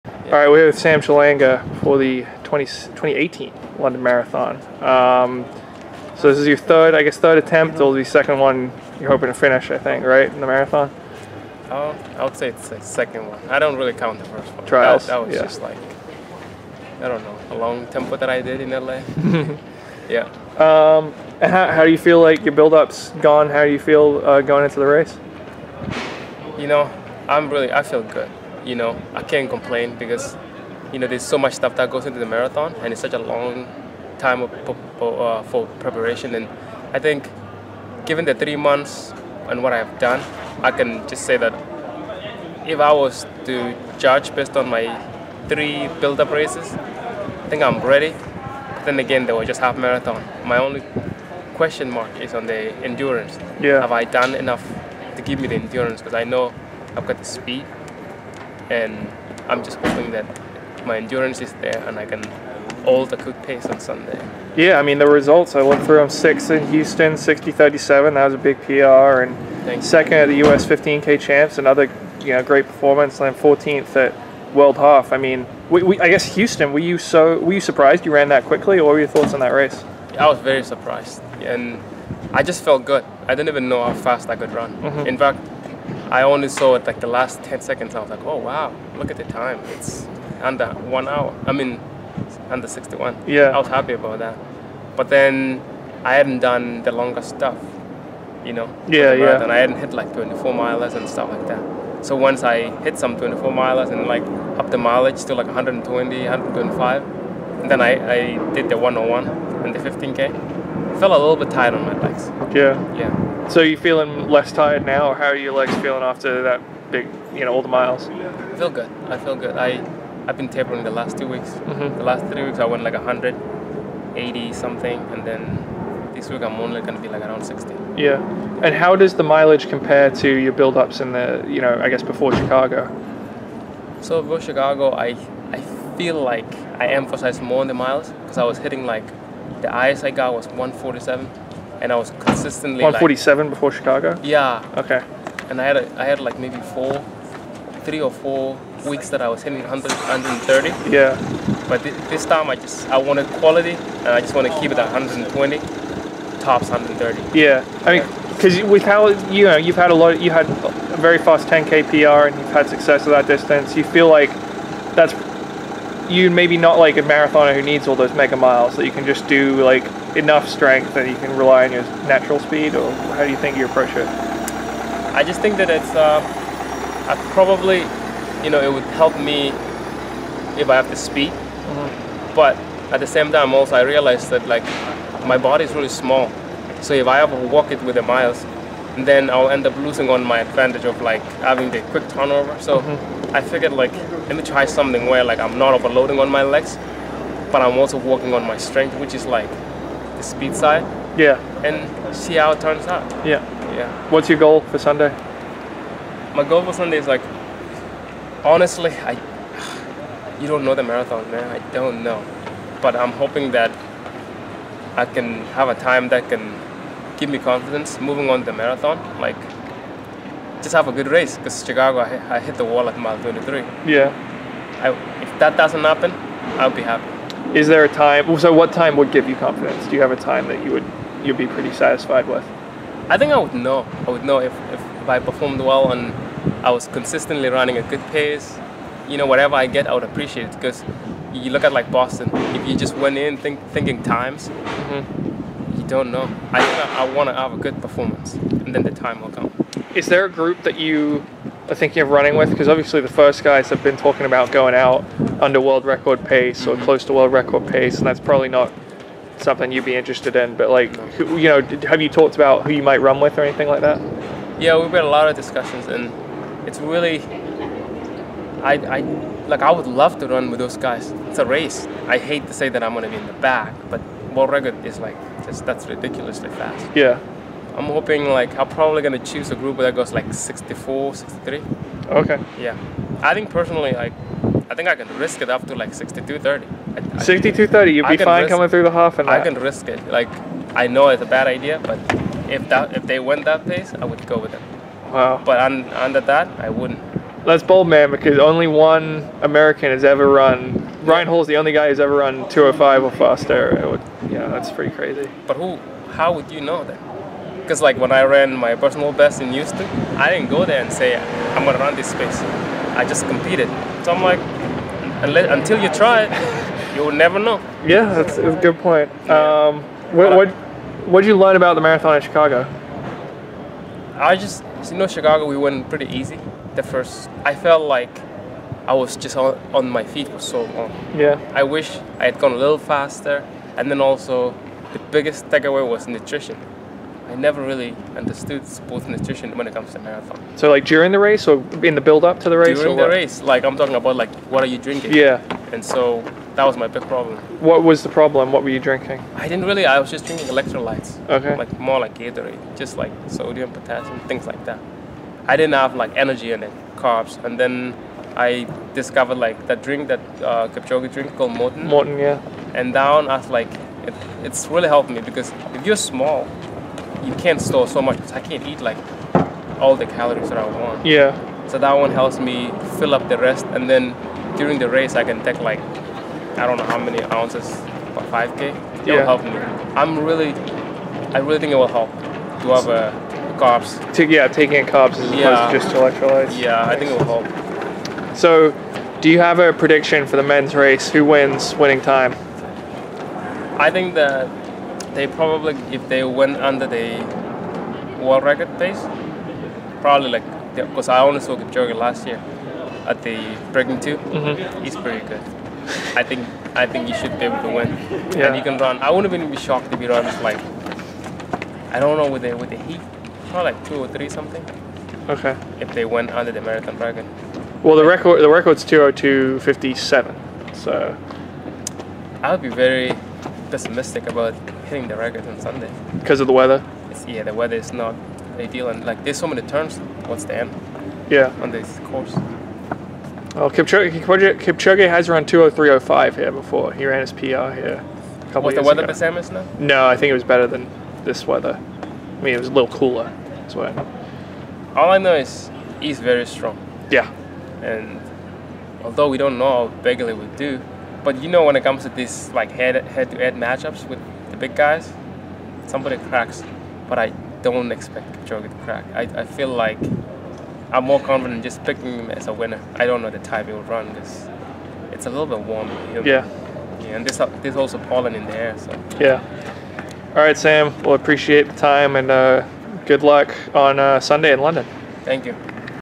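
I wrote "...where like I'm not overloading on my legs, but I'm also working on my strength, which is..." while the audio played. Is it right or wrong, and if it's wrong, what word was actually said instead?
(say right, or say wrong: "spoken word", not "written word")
right.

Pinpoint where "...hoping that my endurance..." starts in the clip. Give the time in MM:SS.
00:59.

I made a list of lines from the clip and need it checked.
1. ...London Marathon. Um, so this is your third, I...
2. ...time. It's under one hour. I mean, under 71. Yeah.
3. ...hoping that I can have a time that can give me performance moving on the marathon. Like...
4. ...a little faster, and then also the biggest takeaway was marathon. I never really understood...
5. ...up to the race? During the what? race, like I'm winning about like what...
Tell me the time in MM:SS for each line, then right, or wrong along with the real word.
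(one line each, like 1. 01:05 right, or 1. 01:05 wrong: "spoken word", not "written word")
1. 00:03 right
2. 01:29 wrong: "61", not "71"
3. 03:33 wrong: "confidence", not "performance"
4. 05:32 wrong: "nutrition", not "marathon"
5. 05:42 wrong: "talking", not "winning".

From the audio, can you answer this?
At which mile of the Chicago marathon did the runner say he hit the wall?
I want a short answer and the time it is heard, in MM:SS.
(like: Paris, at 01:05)
Mile 23, at 03:42.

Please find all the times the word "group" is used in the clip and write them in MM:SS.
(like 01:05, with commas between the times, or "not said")
04:10, 04:39.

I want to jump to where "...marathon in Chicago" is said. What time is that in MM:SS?
05:21.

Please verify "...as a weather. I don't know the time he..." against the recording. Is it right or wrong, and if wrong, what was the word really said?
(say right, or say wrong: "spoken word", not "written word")
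wrong: "winner", not "weather".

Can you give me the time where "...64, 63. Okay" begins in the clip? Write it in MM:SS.
04:40.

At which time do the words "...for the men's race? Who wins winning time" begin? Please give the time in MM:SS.
06:30.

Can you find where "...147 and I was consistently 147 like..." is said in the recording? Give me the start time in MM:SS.
02:20.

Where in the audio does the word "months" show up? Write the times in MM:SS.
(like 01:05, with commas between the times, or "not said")
00:38.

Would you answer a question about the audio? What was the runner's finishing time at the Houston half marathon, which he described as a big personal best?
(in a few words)
60:37.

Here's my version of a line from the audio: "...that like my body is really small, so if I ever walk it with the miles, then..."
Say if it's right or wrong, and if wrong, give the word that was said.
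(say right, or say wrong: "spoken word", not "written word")
right.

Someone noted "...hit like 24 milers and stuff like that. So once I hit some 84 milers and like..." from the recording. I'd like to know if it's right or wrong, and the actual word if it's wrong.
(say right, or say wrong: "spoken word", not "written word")
wrong: "24", not "84".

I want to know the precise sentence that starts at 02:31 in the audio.
But th- this time I just I wanted quality and I just want to keep it at 120, tops 130.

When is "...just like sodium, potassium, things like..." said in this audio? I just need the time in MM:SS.
05:52.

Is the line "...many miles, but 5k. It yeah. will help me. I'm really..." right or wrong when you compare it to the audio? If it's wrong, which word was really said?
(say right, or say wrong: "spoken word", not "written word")
wrong: "ounces", not "miles".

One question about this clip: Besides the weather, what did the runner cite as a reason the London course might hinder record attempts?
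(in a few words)
So many turns.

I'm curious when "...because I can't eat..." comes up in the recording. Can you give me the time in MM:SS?
06:08.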